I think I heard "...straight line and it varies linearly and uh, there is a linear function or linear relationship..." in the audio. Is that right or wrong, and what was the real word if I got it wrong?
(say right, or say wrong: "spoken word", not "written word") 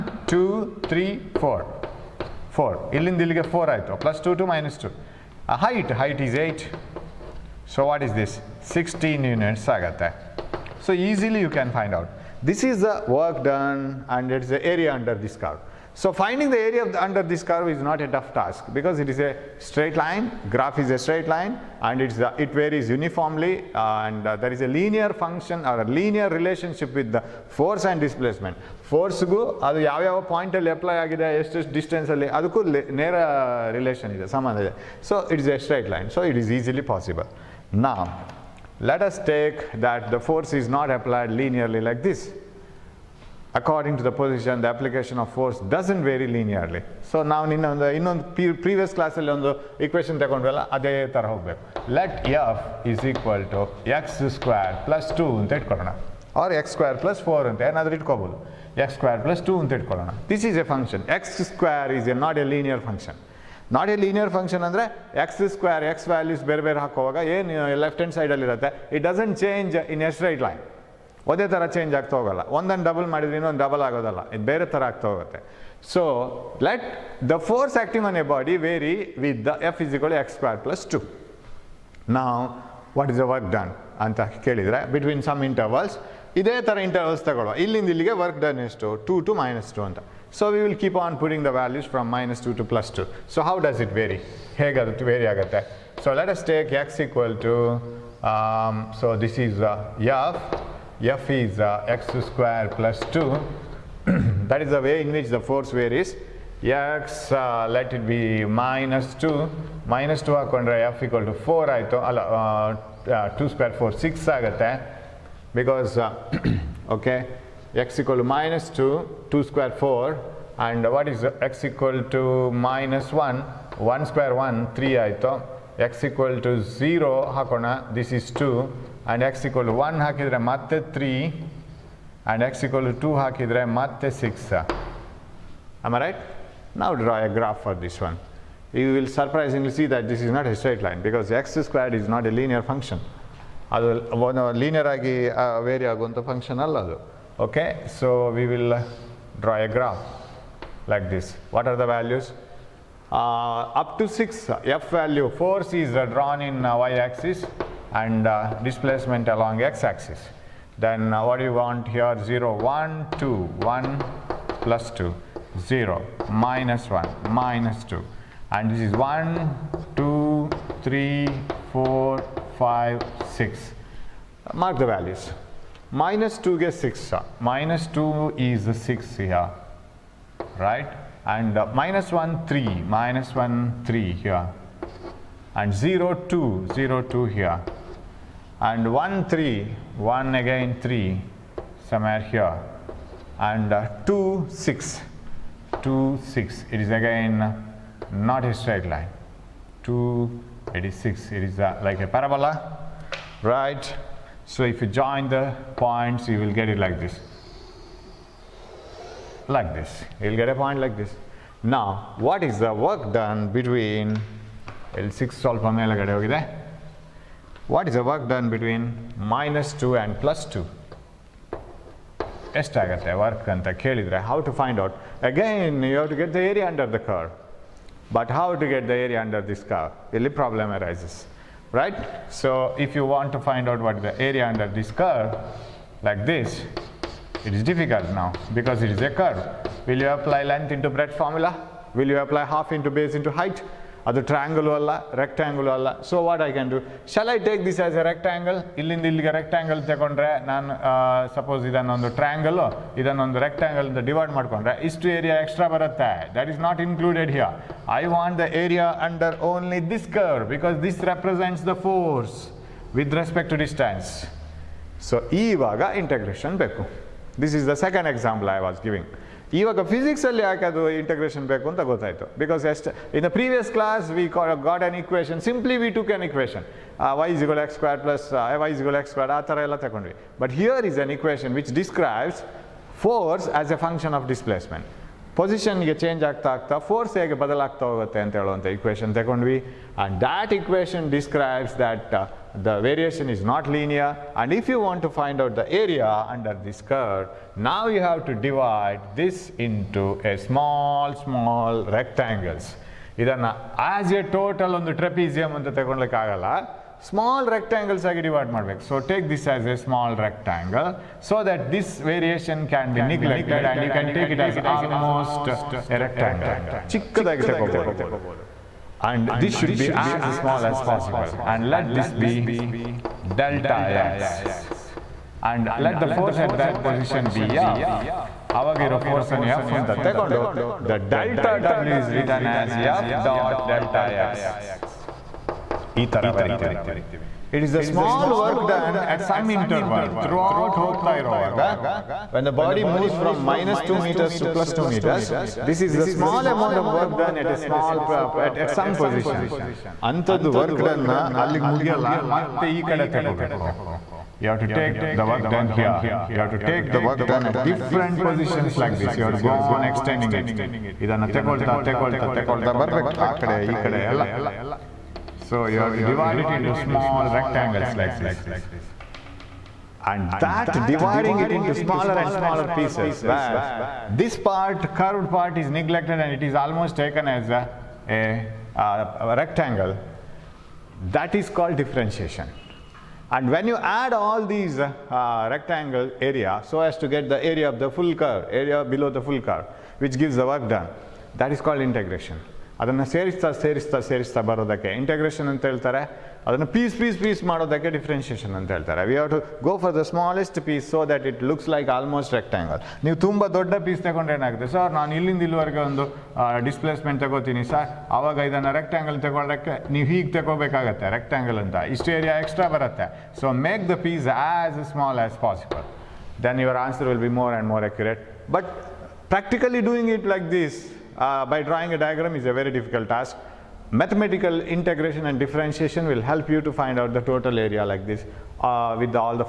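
wrong: "uniformly", not "linearly".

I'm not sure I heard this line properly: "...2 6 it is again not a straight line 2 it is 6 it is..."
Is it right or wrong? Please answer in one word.
right.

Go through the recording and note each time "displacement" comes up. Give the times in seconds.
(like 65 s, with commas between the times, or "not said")
27 s, 158 s.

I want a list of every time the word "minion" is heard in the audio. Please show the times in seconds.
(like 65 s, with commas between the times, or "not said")
not said.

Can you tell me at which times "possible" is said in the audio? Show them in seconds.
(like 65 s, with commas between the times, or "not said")
36 s, 320 s, 415 s.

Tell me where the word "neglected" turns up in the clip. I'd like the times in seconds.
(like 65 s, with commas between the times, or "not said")
313 s, 375 s.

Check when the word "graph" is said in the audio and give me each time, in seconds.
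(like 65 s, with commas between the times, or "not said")
20 s, 137 s.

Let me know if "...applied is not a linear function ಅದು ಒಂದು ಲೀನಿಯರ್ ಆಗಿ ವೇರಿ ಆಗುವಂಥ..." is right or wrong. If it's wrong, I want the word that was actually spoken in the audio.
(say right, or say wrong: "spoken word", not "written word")
wrong: "squared", not "applied".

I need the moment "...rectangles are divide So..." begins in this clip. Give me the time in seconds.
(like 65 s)
307 s.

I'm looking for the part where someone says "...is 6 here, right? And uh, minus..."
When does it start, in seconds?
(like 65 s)
178 s.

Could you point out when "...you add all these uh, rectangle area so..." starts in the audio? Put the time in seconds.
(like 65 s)
383 s.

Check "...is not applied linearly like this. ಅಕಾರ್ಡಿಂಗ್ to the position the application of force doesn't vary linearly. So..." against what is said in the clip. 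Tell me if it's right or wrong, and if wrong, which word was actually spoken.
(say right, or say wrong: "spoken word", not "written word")
right.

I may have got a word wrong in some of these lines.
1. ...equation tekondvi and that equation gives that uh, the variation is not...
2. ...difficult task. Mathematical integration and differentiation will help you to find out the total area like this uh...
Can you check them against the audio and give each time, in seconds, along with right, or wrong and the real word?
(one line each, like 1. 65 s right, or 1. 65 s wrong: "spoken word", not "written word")
1. 288 s wrong: "describes", not "gives"
2. 422 s right.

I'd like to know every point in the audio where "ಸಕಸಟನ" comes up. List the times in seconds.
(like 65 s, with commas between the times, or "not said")
8 s.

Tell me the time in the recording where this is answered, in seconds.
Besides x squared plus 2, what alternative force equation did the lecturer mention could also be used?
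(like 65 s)
56 s.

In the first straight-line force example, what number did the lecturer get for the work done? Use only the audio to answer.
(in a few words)
16.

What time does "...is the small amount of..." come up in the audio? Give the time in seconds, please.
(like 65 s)
345 s.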